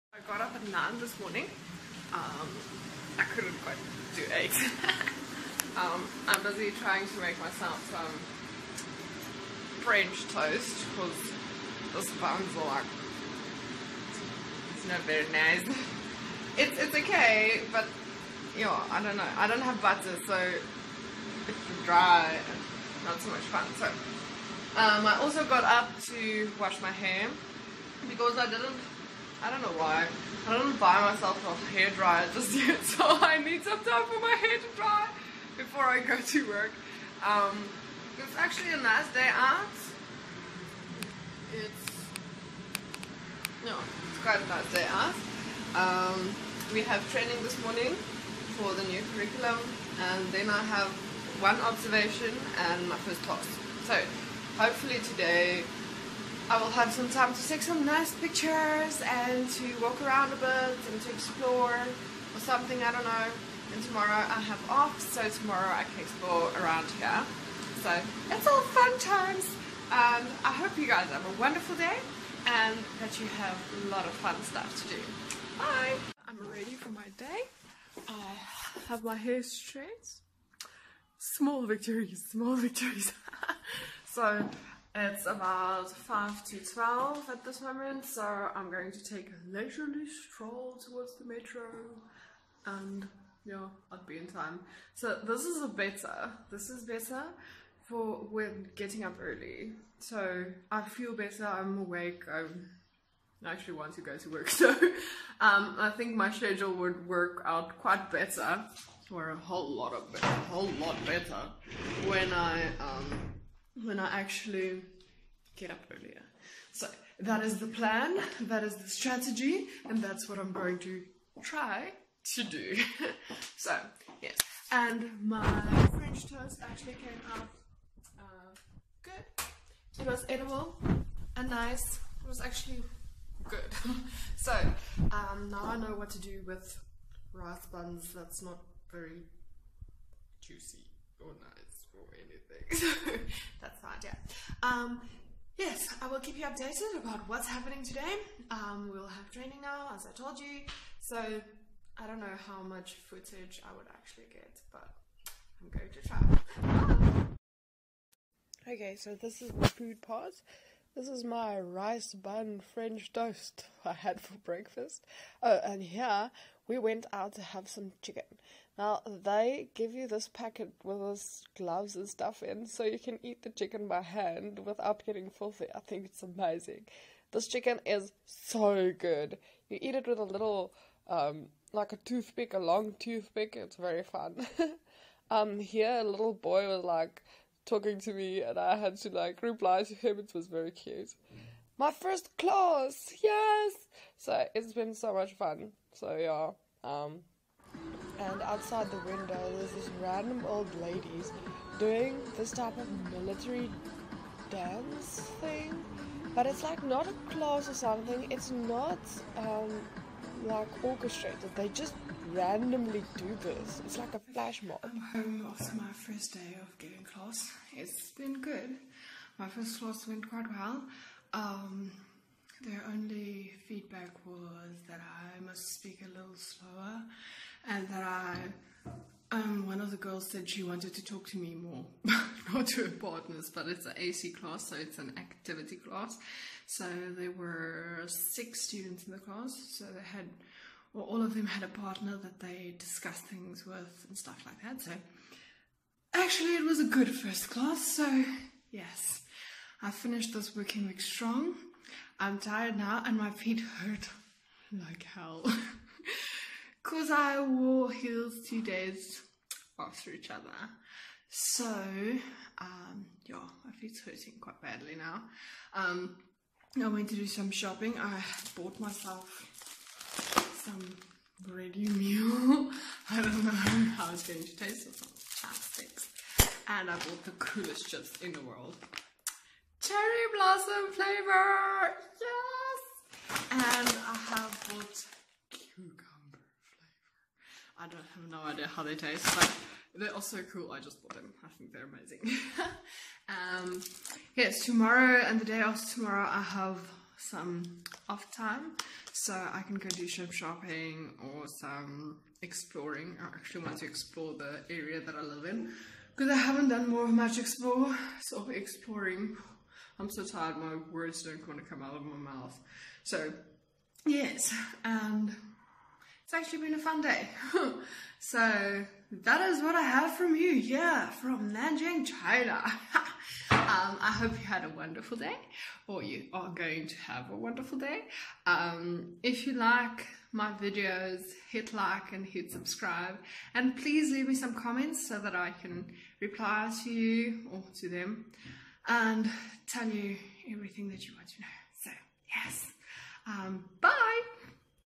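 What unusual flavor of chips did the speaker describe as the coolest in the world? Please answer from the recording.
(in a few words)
Cherry blossom.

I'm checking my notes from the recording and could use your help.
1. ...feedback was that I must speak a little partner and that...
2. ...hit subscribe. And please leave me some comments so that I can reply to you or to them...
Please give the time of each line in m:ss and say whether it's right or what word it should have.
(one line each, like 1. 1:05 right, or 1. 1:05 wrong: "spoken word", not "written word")
1. 3:43 wrong: "slower", not "partner"
2. 5:32 right.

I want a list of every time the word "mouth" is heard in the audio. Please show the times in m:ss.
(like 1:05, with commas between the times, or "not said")
5:12.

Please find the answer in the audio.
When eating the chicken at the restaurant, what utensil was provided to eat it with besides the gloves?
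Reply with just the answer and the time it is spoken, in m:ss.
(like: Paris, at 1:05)
A long toothpick, at 3:02.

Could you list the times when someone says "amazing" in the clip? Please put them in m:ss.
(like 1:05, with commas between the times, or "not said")
2:56, 4:51.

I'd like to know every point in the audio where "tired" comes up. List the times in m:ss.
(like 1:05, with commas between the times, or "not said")
4:12, 5:10.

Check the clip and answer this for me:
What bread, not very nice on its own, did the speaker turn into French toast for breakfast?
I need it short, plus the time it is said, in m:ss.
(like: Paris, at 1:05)
Rice buns, at 2:17.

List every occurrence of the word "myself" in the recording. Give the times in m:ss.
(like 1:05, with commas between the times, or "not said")
0:07, 0:31, 4:28.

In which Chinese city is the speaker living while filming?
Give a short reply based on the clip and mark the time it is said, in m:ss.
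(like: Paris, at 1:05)
Nanjing, at 5:21.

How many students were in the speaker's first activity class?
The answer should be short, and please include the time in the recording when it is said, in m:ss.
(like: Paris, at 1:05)
6, at 3:58.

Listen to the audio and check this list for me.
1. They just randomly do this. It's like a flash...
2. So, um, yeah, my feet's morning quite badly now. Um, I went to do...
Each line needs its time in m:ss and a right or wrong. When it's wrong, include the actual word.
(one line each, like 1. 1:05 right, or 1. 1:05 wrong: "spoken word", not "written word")
1. 3:31 right
2. 4:21 wrong: "hurting", not "morning".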